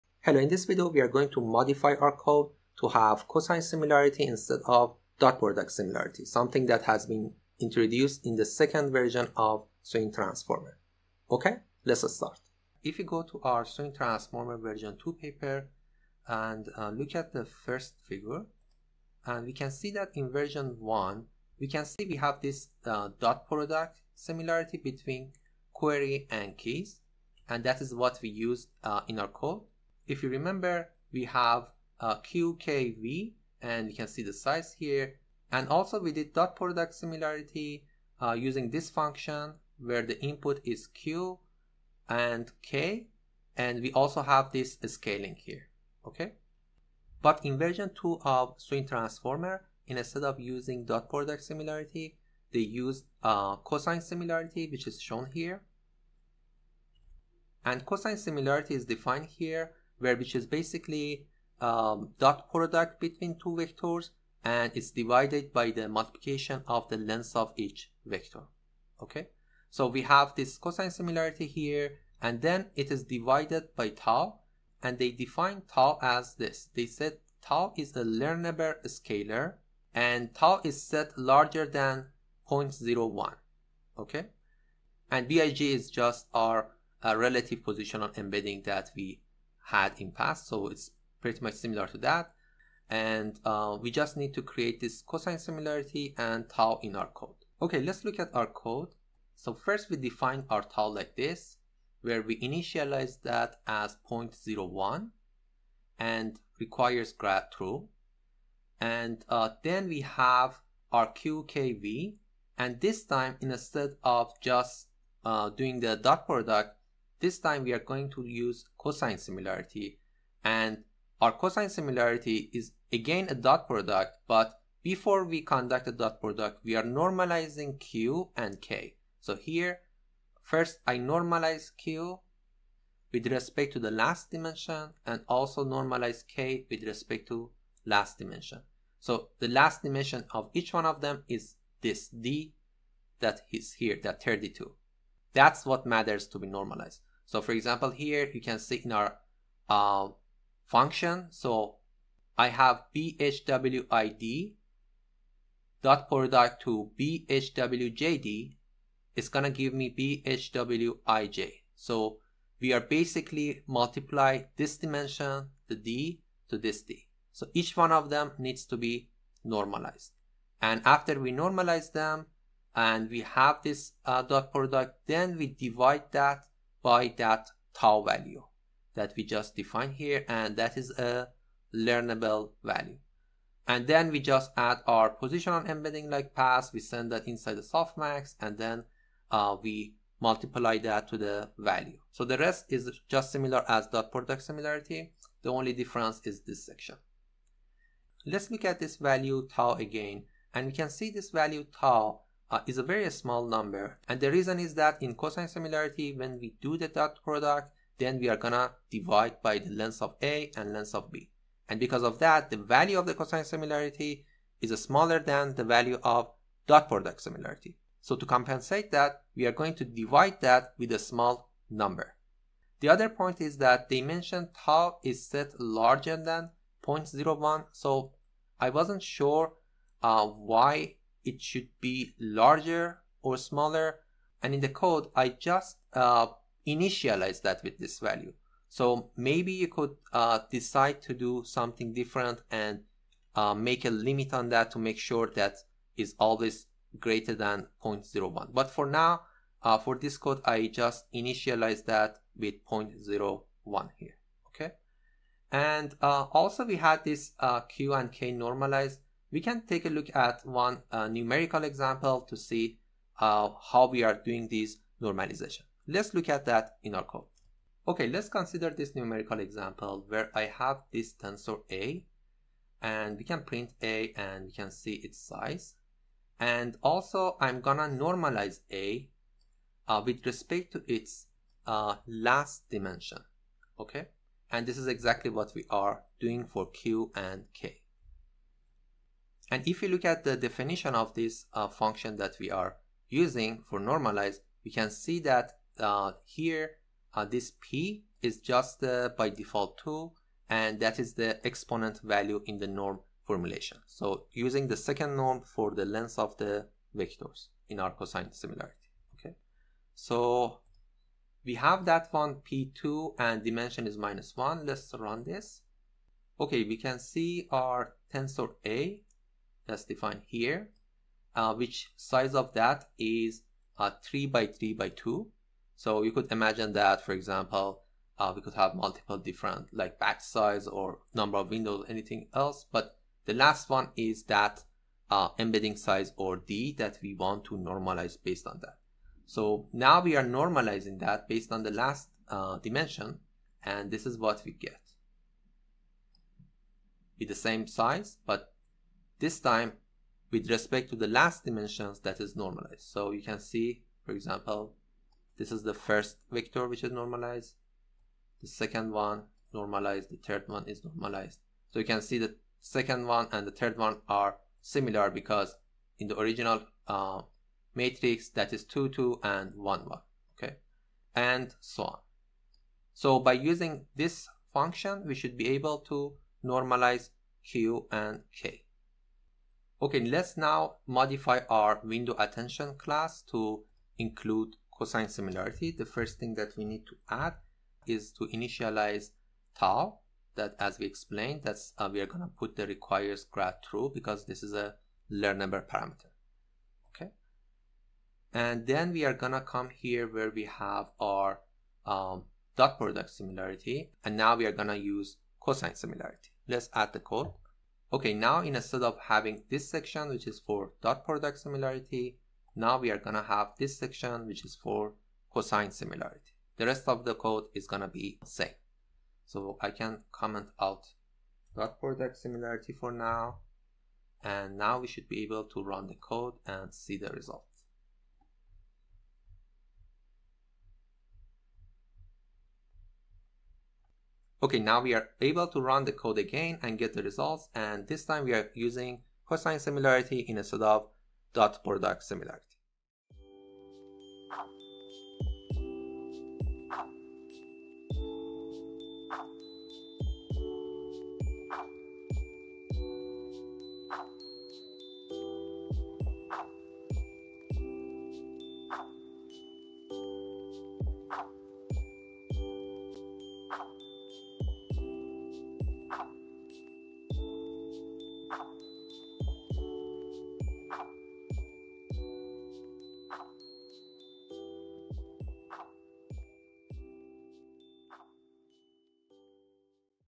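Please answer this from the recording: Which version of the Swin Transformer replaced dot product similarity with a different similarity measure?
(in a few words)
second version.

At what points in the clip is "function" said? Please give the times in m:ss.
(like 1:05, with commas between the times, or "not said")
0:38, 2:30, 4:51, 6:14.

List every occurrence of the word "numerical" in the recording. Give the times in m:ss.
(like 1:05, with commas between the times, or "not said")
4:21, 4:28.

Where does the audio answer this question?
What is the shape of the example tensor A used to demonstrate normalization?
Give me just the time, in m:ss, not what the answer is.
5:24.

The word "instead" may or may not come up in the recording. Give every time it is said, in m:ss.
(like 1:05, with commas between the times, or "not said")
0:04, 0:49, 1:53, 6:48, 7:20.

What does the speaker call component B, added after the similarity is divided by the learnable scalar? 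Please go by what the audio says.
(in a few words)
relative positional embedding.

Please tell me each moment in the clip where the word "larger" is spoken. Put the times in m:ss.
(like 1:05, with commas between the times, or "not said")
1:21, 3:45, 3:52.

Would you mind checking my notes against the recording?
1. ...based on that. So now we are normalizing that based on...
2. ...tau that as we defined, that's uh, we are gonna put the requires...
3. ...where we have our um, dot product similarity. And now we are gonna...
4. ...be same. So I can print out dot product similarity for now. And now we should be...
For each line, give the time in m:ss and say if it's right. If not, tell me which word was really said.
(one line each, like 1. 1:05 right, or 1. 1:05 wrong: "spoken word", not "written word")
1. 5:38 right
2. 6:29 wrong: "explained", not "defined"
3. 6:40 right
4. 6:57 wrong: "comment", not "print".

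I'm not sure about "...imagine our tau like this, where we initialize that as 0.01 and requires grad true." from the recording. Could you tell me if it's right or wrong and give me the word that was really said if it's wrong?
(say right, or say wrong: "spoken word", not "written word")
wrong: "define", not "imagine".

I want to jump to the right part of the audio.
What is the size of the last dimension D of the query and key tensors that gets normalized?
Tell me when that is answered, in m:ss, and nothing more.
2:24.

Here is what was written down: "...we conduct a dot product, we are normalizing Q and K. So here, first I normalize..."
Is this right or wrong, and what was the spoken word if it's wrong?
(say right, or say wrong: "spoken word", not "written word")
right.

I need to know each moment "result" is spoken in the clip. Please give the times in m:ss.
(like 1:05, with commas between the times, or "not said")
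7:07, 7:17.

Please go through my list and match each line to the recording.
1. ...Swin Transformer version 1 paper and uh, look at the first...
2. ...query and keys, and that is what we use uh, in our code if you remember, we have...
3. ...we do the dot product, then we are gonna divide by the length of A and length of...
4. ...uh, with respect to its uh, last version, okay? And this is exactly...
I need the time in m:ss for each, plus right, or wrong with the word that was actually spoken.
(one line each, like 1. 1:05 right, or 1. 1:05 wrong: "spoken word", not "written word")
1. 0:13 wrong: "2", not "1"
2. 0:25 right
3. 3:26 right
4. 4:39 wrong: "dimension", not "version".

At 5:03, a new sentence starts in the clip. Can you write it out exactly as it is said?
So using the second norm for the length of the vectors in our cosine similarity.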